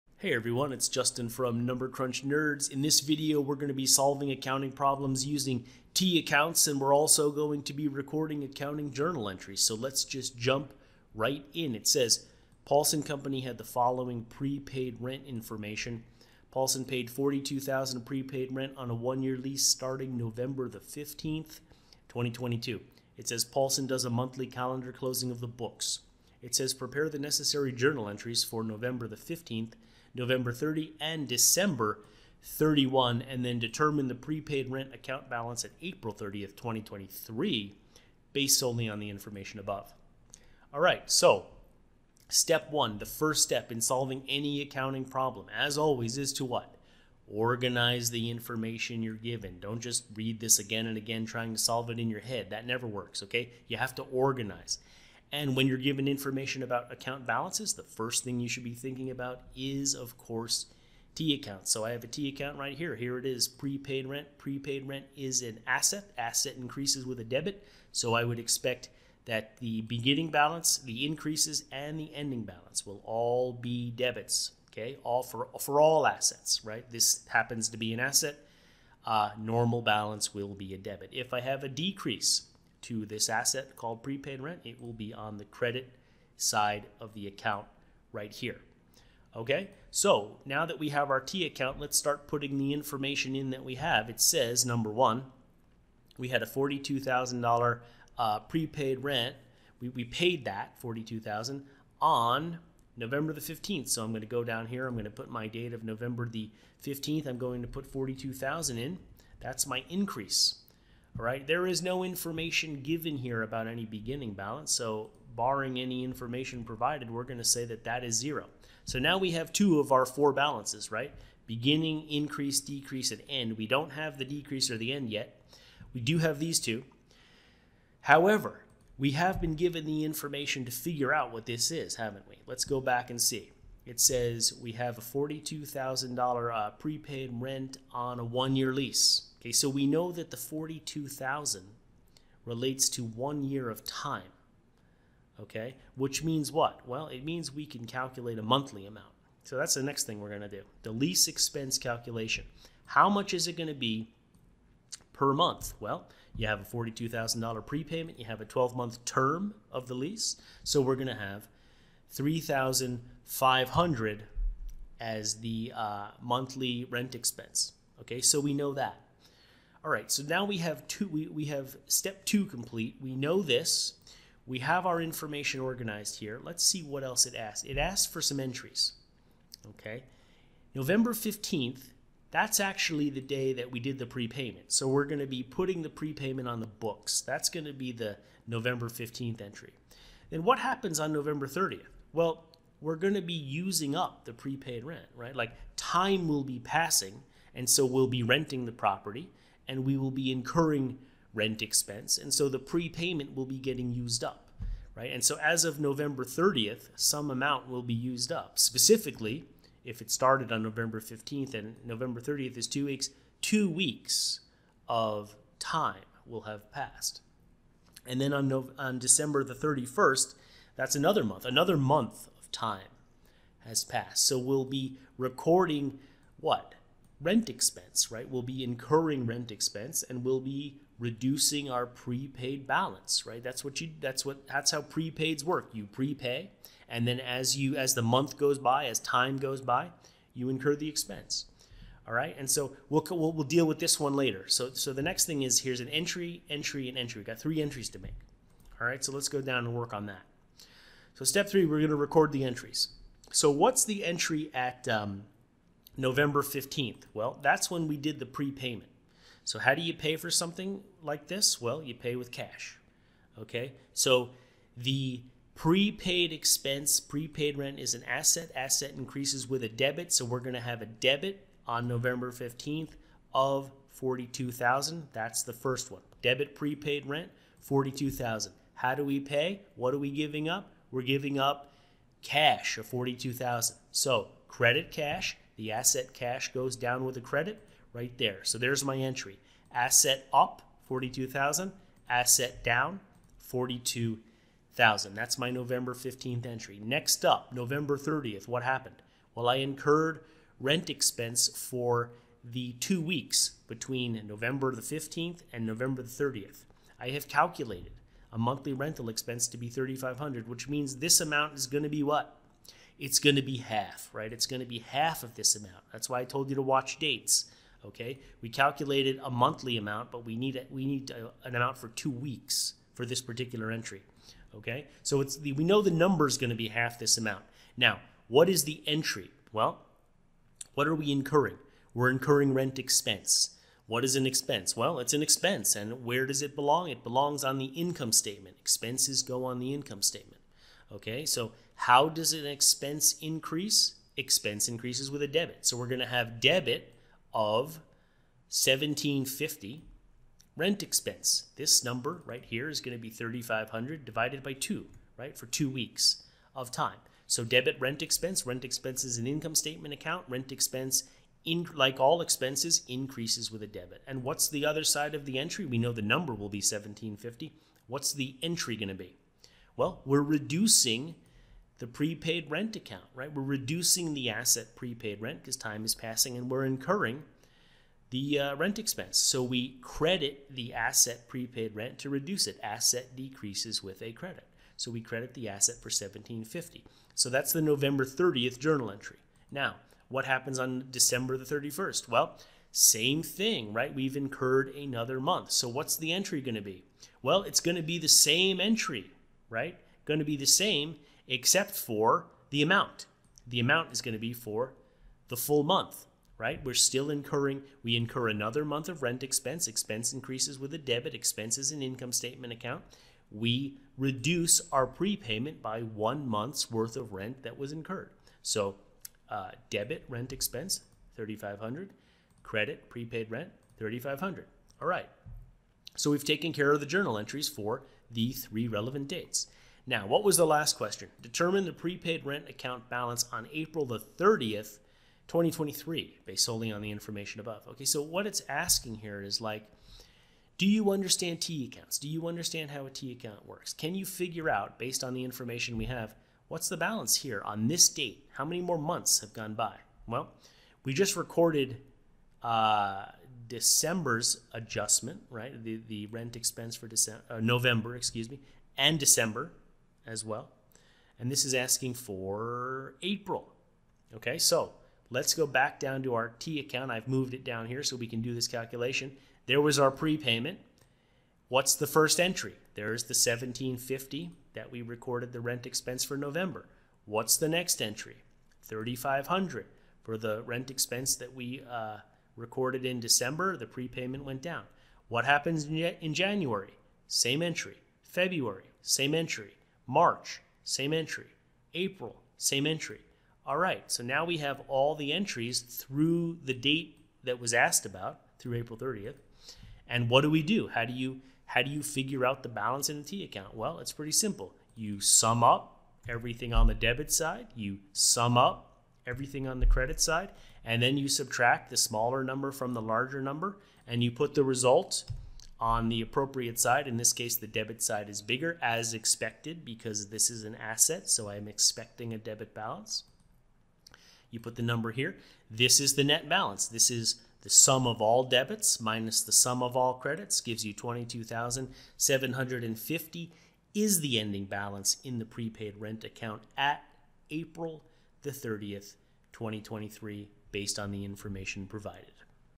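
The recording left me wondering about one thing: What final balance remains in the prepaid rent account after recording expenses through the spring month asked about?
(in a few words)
22,750.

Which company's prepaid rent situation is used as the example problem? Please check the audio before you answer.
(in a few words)
Paulson Company.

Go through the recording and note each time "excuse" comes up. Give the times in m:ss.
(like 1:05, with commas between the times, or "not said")
7:37.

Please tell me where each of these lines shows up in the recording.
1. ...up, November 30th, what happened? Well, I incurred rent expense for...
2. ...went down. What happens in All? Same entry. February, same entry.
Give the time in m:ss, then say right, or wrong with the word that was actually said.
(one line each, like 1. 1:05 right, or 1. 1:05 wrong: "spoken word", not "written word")
1. 4:57 right
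2. 8:04 wrong: "January", not "All".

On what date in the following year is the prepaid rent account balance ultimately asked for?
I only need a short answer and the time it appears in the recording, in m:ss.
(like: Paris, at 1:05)
April 30th, 2023, at 0:35.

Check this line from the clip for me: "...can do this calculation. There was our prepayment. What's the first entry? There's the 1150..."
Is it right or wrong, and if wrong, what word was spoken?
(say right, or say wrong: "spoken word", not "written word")
wrong: "1750", not "1150".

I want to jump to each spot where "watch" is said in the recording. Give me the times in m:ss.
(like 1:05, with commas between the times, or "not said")
5:16.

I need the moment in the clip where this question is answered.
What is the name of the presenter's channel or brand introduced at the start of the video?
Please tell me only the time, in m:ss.
0:01.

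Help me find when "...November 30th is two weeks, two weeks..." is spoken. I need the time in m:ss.
3:31.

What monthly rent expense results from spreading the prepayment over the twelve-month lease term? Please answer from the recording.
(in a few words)
3,500.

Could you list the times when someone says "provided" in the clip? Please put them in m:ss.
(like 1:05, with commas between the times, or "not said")
1:56, 9:01.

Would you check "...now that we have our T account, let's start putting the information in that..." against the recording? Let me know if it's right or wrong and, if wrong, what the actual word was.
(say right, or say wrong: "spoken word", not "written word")
right.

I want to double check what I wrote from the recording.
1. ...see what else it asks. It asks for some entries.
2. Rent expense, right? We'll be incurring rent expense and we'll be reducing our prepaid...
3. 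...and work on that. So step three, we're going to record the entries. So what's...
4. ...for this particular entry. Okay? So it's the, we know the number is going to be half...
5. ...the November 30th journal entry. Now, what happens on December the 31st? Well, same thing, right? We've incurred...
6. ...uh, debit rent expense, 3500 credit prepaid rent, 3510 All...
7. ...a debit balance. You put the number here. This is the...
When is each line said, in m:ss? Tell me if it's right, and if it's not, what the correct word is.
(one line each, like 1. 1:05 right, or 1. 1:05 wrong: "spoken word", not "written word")
1. 2:56 right
2. 3:47 right
3. 4:09 right
4. 5:22 right
5. 6:27 right
6. 6:59 wrong: "3500", not "3510"
7. 8:42 right.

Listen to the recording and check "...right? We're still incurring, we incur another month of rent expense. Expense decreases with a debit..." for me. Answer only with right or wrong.
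wrong.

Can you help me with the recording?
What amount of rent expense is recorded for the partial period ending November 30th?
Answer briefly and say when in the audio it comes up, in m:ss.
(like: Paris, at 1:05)
1,750, at 5:46.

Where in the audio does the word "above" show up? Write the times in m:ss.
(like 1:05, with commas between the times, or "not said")
0:39, 7:17.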